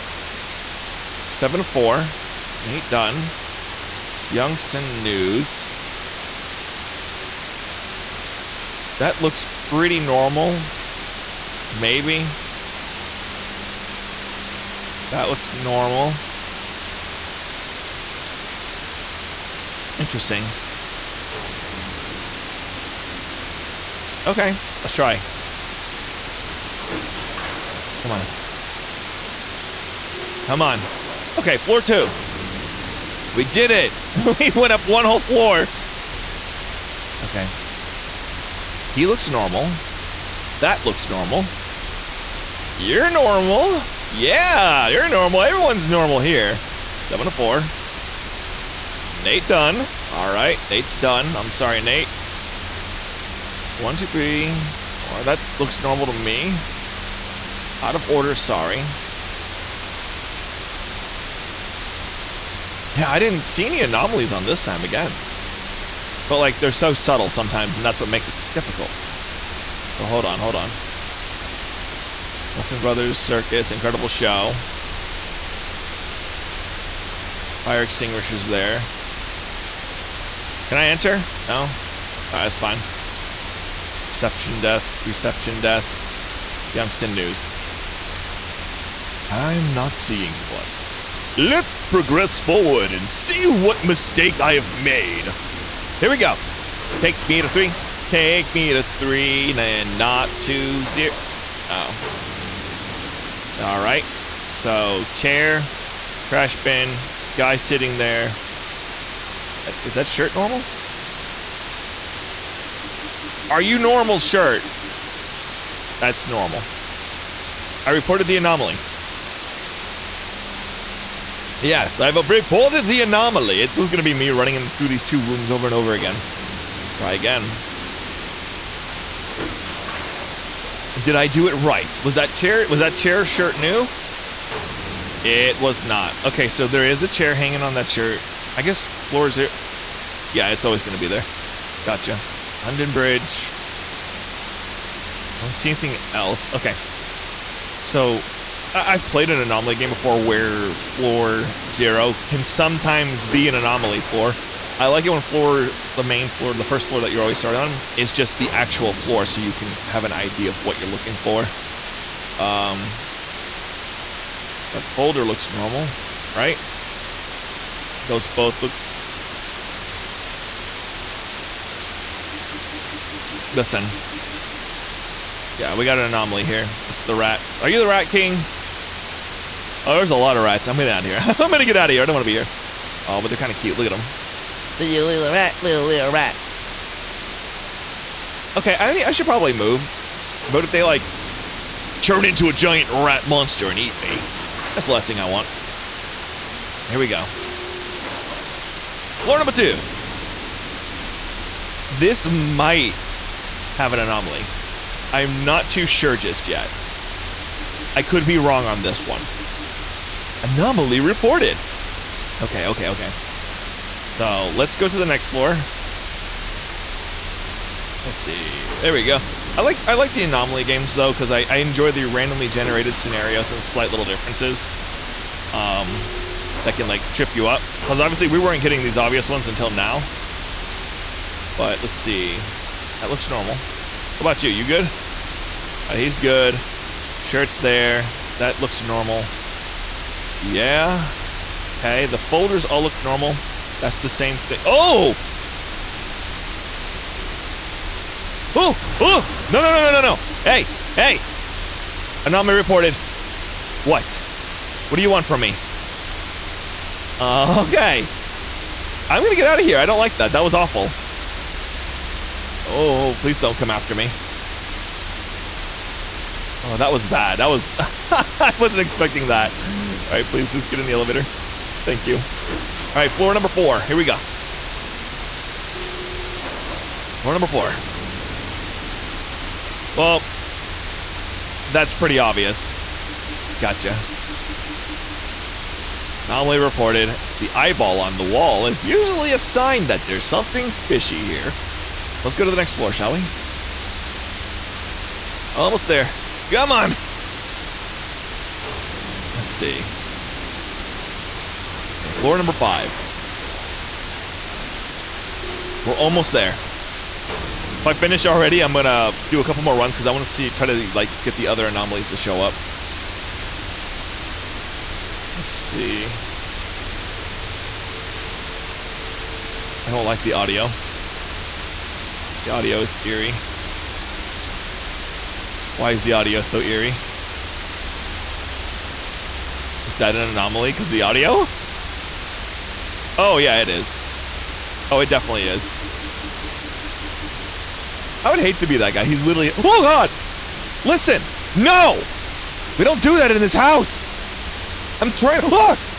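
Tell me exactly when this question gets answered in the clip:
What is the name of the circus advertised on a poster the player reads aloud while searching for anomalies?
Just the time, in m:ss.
1:12.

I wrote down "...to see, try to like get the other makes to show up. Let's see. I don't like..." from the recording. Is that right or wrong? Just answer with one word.
wrong.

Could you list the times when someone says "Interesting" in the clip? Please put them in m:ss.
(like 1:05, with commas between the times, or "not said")
0:19.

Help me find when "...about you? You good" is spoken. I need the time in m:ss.
3:54.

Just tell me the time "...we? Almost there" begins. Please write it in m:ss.
4:53.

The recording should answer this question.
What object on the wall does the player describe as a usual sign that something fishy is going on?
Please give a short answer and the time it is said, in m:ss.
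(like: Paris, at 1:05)
The eyeball, at 4:47.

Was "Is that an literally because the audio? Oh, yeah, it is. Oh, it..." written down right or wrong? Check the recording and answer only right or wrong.
wrong.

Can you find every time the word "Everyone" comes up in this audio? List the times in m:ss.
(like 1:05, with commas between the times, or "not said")
0:45.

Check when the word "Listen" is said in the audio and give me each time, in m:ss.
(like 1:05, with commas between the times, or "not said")
2:53, 5:40.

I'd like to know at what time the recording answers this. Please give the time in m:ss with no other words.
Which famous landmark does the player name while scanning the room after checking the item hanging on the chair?
2:22.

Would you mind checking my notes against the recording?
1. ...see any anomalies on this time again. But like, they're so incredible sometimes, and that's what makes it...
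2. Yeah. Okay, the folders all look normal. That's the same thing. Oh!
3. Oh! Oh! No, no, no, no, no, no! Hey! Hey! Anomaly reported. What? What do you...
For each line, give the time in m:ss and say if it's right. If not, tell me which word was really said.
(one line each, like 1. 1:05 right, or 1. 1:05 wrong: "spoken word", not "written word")
1. 1:03 wrong: "subtle", not "incredible"
2. 4:00 right
3. 4:08 right.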